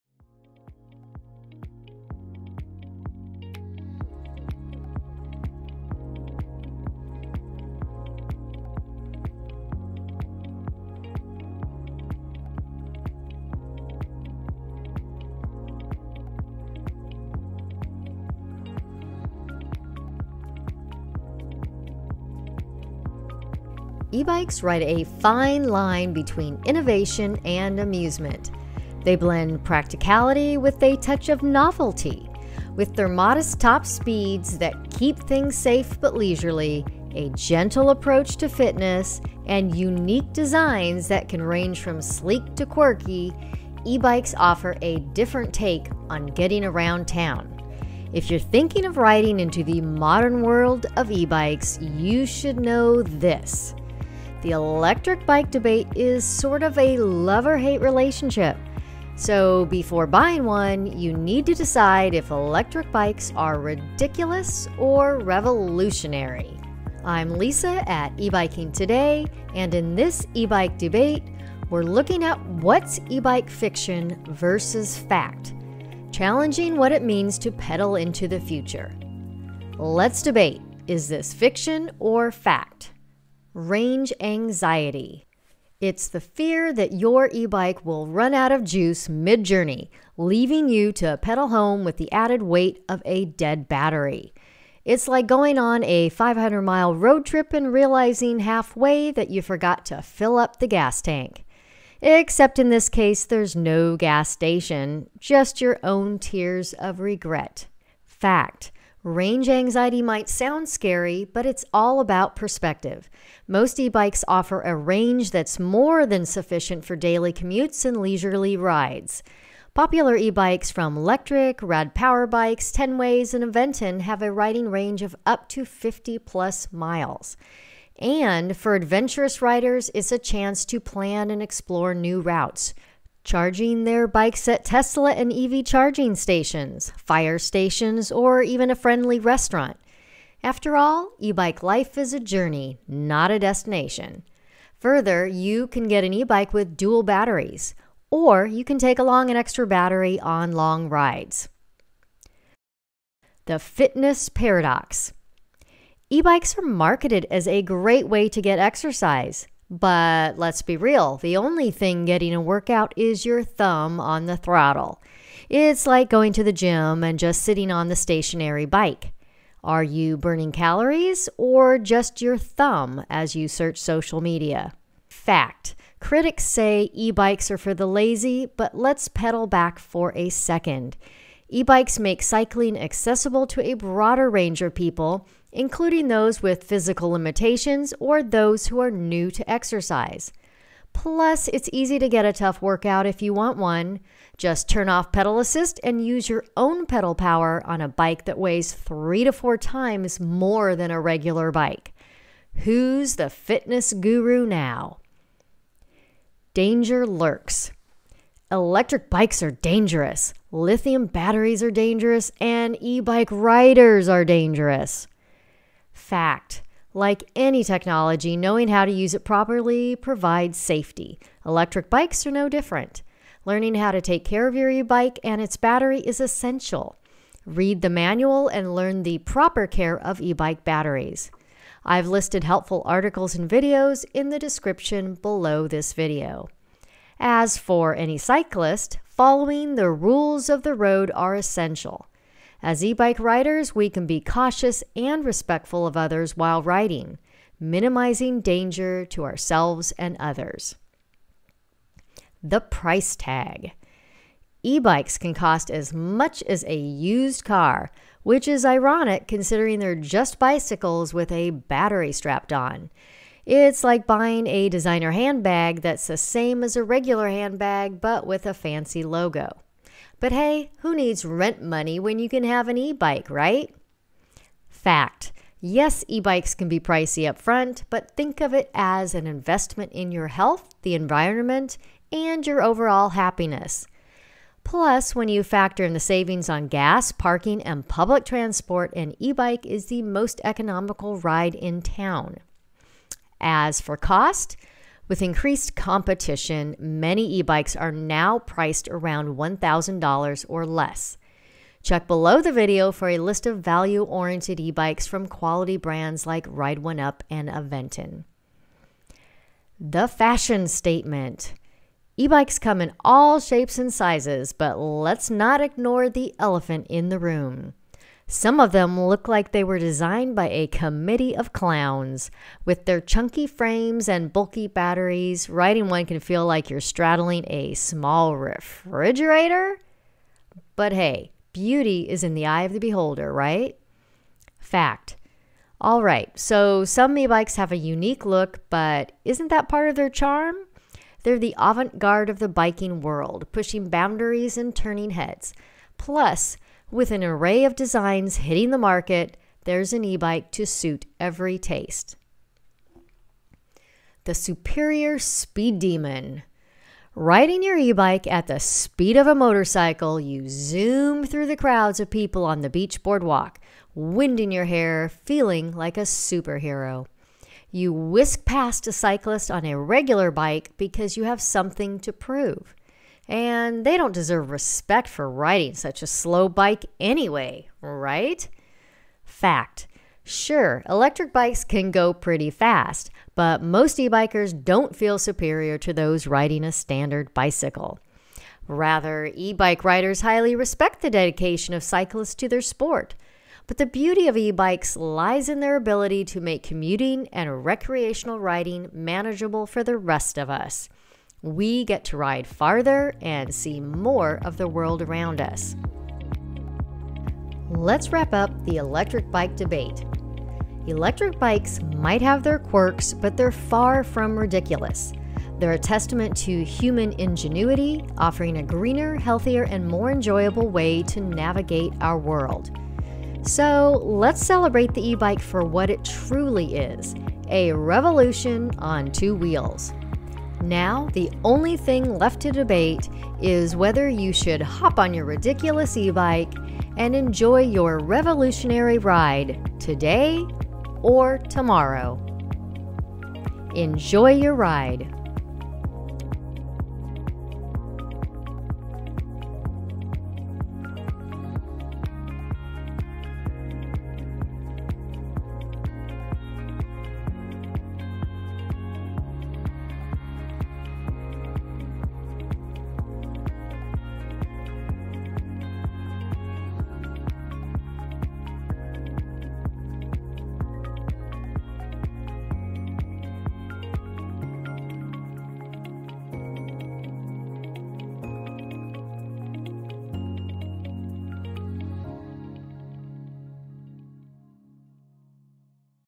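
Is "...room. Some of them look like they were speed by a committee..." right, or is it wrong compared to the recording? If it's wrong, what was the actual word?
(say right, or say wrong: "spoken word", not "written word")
wrong: "designed", not "speed".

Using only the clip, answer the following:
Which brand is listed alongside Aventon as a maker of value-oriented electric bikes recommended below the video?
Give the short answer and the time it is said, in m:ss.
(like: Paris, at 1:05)
Ride1Up, at 5:06.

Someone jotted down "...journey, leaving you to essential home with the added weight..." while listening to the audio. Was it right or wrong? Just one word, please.
wrong.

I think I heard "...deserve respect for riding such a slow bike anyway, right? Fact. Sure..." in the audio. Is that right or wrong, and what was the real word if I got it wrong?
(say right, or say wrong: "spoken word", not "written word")
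right.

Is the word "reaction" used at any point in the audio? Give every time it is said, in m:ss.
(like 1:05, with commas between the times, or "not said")
not said.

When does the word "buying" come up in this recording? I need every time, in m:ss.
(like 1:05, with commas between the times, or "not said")
1:00, 4:24.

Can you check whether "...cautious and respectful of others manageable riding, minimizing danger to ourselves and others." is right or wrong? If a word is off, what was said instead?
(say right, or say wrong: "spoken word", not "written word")
wrong: "while", not "manageable".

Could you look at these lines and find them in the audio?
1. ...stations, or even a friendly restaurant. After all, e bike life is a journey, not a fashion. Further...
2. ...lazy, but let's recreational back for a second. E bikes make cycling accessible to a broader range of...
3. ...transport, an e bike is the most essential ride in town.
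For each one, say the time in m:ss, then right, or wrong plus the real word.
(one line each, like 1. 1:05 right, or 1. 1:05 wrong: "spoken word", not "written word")
1. 2:17 wrong: "destination", not "fashion"
2. 2:57 wrong: "pedal", not "recreational"
3. 4:48 wrong: "economical", not "essential".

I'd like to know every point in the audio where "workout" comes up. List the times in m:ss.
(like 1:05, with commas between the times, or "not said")
2:42, 3:12.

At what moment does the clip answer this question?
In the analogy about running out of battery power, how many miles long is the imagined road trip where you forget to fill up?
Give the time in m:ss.
1:36.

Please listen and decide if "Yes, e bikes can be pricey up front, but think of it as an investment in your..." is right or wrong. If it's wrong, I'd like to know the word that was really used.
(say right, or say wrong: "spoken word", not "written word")
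right.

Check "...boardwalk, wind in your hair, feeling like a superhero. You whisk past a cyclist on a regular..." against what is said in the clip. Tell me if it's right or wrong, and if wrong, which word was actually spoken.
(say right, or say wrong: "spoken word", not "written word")
right.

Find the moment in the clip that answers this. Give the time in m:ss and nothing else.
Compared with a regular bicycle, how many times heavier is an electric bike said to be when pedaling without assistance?
3:18.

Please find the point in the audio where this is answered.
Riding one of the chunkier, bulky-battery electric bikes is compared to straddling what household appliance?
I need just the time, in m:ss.
5:27.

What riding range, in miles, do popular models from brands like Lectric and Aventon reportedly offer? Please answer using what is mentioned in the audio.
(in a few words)
50 plus miles.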